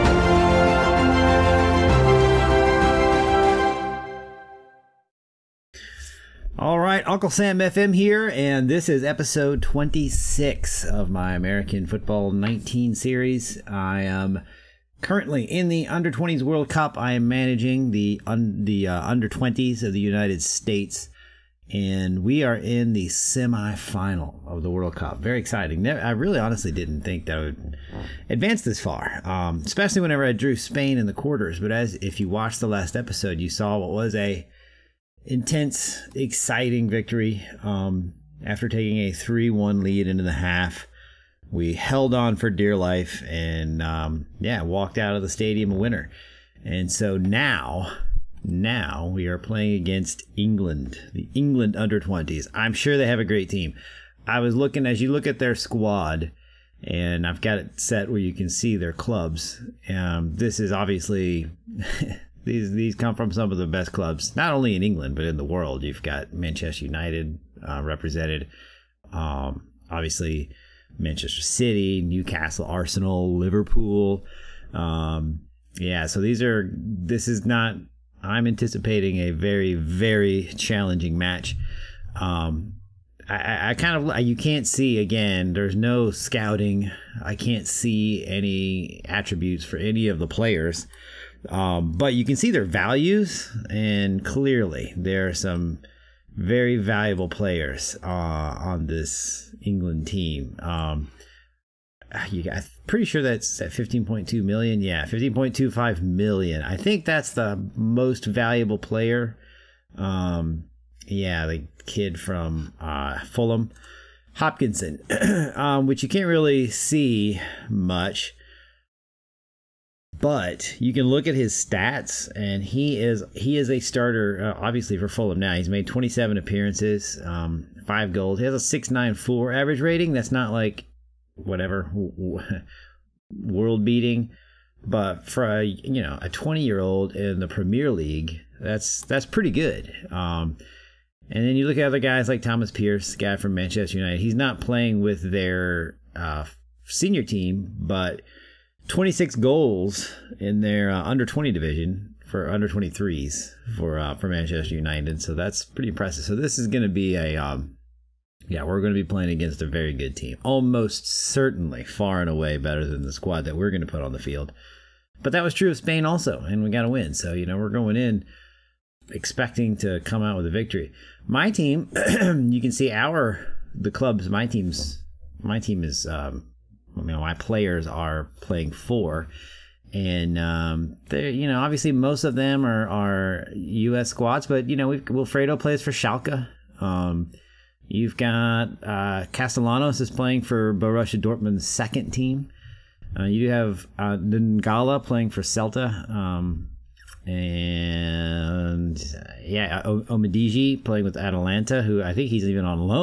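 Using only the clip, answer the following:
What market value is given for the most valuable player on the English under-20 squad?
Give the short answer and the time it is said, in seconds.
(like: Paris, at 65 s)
15.25 million, at 105 s.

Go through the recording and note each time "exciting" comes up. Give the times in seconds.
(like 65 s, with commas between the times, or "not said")
25 s, 36 s.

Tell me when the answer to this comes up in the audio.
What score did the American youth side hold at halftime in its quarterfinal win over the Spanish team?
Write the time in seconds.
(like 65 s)
39 s.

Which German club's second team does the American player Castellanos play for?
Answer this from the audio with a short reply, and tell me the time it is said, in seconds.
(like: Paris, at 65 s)
Borussia Dortmund, at 190 s.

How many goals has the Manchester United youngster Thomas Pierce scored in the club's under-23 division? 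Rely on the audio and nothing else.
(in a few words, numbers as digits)
26.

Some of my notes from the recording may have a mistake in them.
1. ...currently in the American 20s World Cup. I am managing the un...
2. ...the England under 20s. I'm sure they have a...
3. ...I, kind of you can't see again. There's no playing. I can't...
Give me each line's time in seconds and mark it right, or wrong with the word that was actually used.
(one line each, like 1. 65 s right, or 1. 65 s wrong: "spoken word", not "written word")
1. 15 s wrong: "Under", not "American"
2. 51 s right
3. 83 s wrong: "scouting", not "playing".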